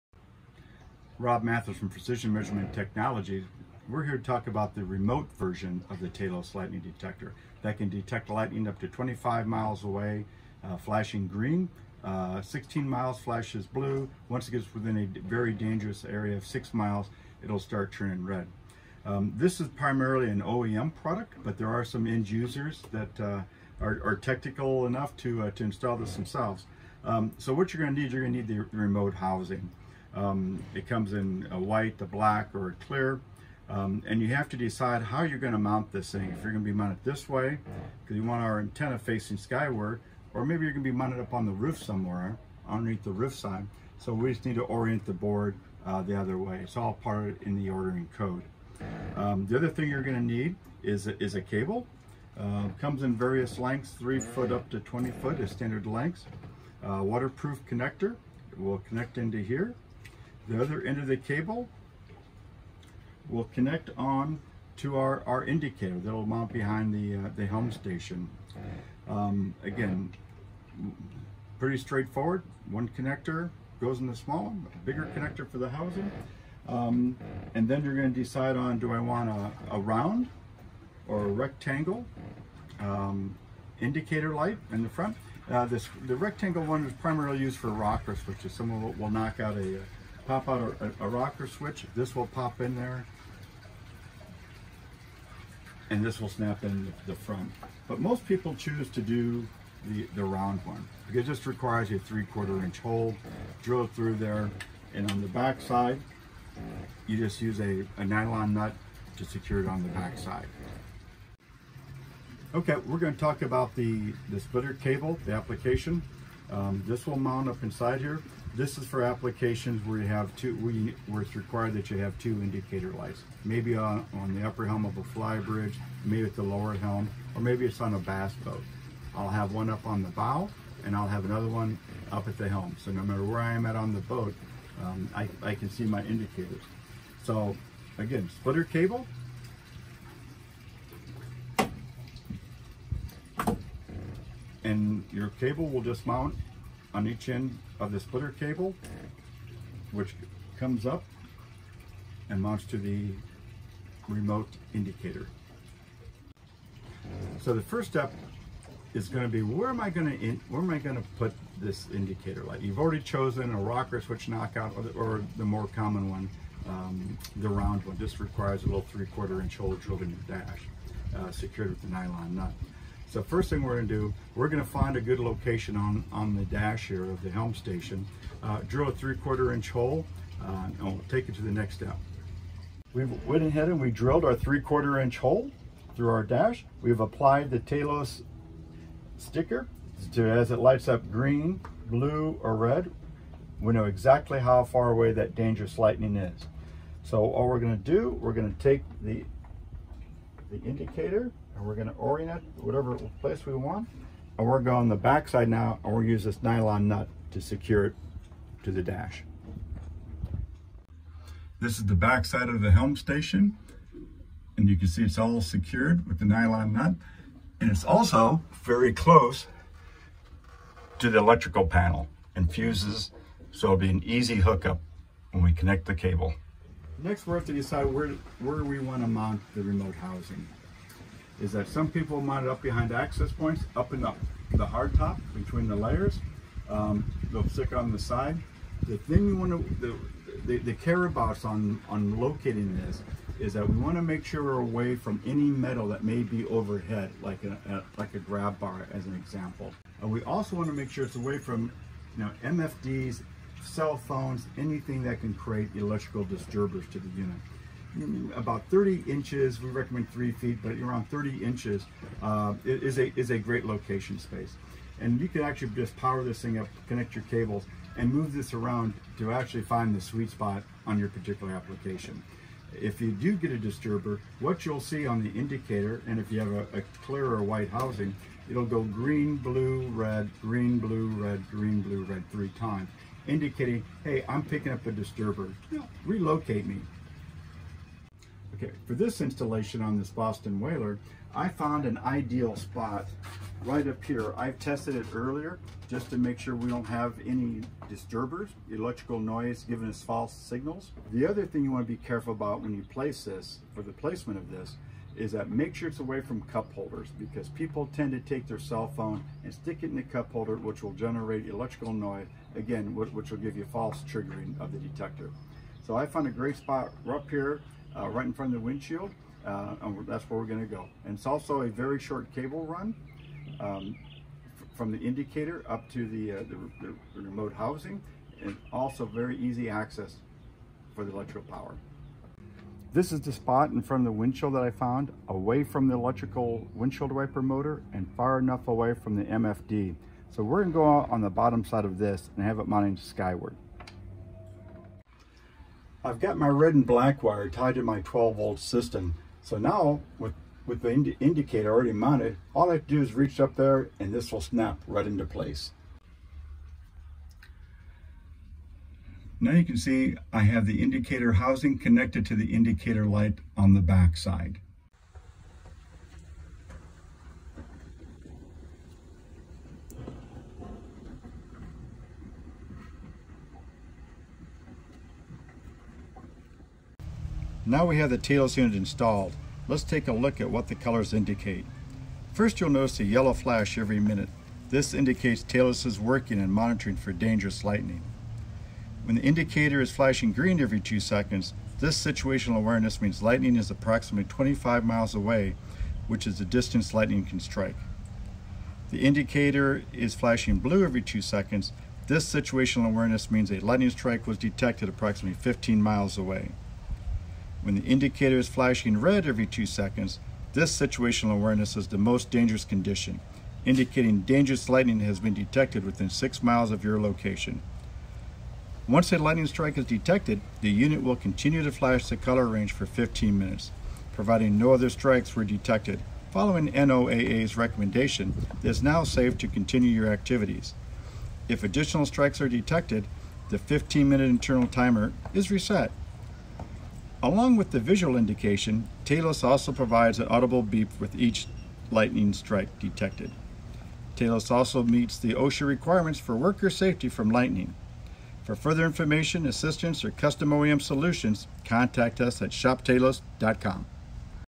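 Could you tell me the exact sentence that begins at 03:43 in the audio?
So it'll be an easy hookup when we connect the cable.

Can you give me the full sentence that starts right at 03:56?
Um, they'll stick on the side.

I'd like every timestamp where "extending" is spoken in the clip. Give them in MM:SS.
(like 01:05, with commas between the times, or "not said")
not said.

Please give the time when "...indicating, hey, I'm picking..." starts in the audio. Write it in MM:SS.
04:43.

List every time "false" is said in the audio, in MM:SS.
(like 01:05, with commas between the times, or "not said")
05:00, 05:13.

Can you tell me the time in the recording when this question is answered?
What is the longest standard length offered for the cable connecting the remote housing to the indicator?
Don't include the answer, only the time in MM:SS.
00:54.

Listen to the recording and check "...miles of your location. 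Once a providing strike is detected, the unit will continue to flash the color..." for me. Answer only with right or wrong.
wrong.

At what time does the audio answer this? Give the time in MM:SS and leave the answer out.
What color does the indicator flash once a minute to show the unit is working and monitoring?
06:23.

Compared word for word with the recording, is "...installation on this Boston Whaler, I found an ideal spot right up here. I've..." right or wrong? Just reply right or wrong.
right.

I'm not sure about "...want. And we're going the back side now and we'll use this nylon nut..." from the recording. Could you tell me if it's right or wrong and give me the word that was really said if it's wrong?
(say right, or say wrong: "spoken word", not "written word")
right.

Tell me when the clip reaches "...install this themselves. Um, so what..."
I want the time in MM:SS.
00:25.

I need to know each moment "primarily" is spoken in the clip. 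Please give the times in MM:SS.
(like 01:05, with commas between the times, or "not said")
00:19, 01:27.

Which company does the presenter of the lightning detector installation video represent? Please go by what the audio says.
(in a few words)
Precision Measurement Technology.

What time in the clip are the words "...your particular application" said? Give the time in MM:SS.
04:30.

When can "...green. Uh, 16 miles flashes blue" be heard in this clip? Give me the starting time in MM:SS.
00:11.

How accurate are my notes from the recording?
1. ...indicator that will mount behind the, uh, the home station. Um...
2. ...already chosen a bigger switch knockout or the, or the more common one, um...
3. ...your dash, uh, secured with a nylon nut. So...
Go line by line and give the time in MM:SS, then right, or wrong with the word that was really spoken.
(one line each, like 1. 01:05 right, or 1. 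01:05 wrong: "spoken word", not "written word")
1. 01:05 right
2. 02:42 wrong: "rocker", not "bigger"
3. 02:50 right.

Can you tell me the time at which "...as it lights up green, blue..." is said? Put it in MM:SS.
03:10.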